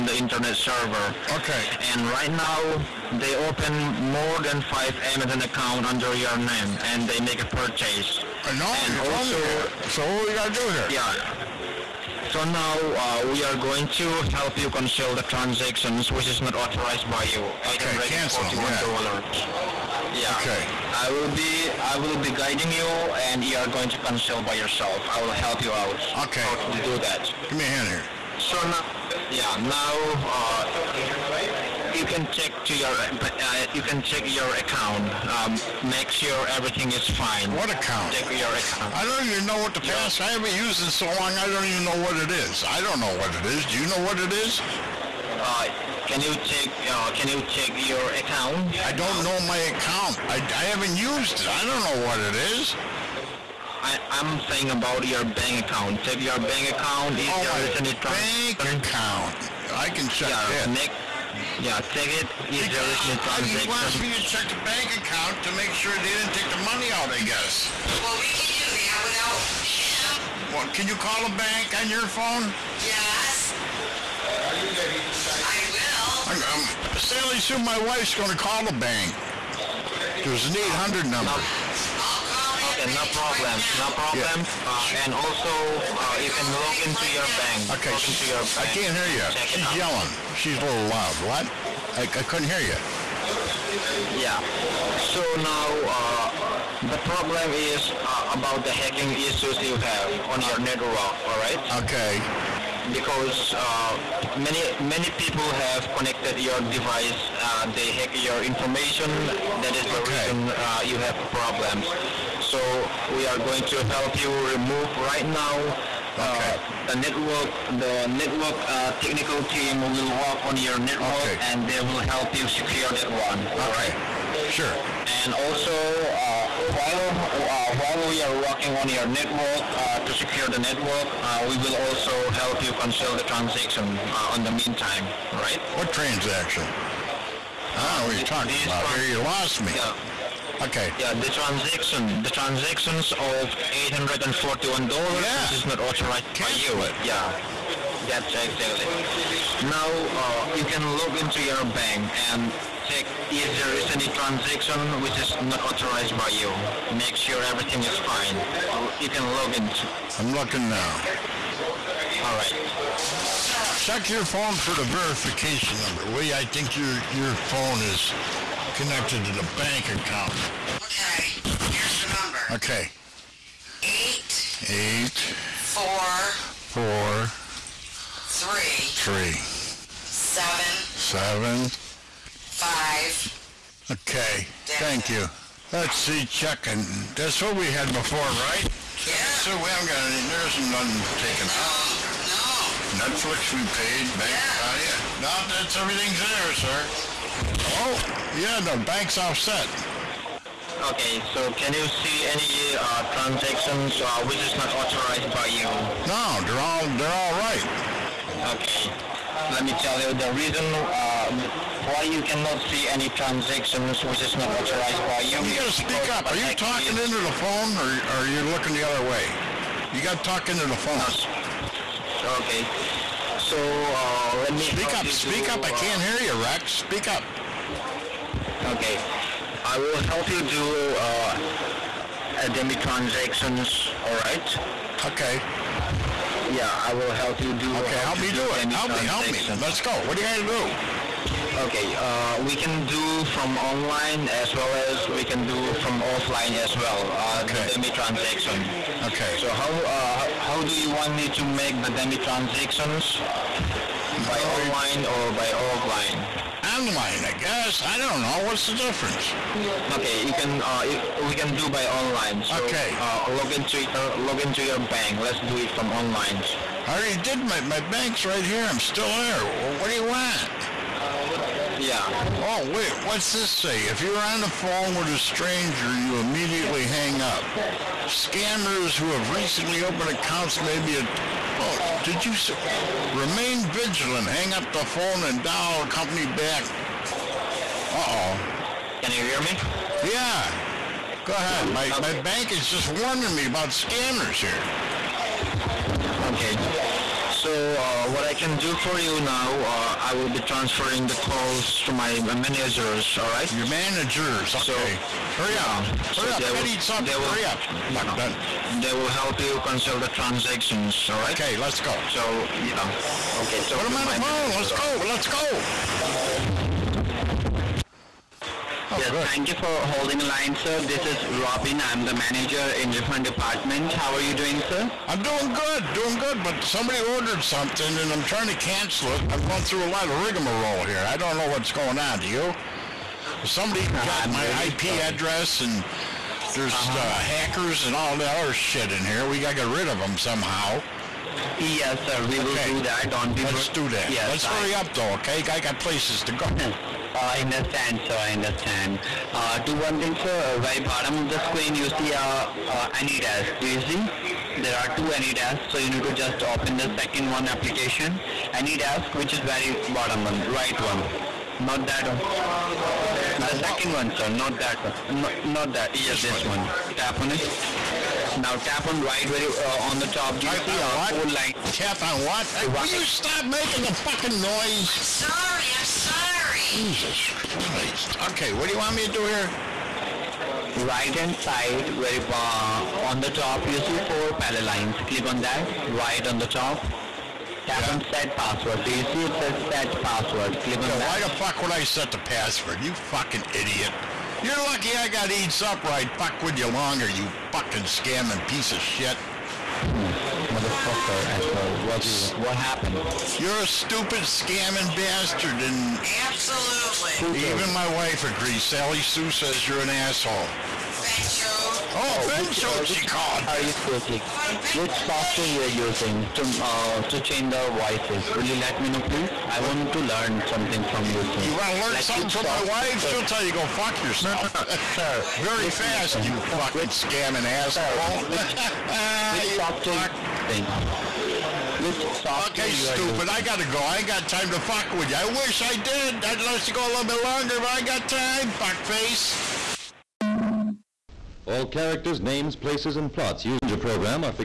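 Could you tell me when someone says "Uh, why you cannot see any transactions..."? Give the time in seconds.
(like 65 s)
210 s.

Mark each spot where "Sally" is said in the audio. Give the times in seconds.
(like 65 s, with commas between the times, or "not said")
76 s, 408 s.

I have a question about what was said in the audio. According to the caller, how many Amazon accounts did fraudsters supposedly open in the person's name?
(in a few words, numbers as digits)
more than 5.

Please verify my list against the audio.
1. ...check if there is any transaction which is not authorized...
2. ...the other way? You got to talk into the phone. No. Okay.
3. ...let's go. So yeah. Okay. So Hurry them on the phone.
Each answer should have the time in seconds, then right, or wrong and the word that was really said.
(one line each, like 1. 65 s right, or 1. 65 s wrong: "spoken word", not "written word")
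1. 152 s right
2. 218 s right
3. 311 s wrong: "Put", not "Hurry".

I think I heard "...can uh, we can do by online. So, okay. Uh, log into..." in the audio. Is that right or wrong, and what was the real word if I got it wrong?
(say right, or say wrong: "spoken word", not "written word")
right.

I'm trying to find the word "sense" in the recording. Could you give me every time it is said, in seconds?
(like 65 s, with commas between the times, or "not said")
not said.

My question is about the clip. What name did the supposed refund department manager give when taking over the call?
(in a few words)
Robin.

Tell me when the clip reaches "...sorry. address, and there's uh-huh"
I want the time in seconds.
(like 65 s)
334 s.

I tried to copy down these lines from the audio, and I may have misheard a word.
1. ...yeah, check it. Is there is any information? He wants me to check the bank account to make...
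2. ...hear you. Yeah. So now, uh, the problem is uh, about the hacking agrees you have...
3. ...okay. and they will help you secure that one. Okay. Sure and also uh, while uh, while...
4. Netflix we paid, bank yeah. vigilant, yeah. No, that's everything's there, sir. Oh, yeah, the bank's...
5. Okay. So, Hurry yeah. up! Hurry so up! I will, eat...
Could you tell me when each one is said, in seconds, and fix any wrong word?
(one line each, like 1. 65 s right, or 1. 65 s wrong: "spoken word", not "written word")
1. 61 s wrong: "transaction", not "information"
2. 92 s wrong: "issues", not "agrees"
3. 121 s right
4. 193 s wrong: "account", not "vigilant"
5. 304 s right.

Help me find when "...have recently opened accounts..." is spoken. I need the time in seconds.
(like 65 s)
279 s.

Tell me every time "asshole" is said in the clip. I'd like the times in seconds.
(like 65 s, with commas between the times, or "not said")
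401 s, 409 s, 427 s.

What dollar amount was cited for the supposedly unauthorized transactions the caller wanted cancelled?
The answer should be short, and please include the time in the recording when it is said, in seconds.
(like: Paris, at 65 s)
$841, at 143 s.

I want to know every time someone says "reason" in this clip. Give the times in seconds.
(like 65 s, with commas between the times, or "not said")
110 s, 210 s.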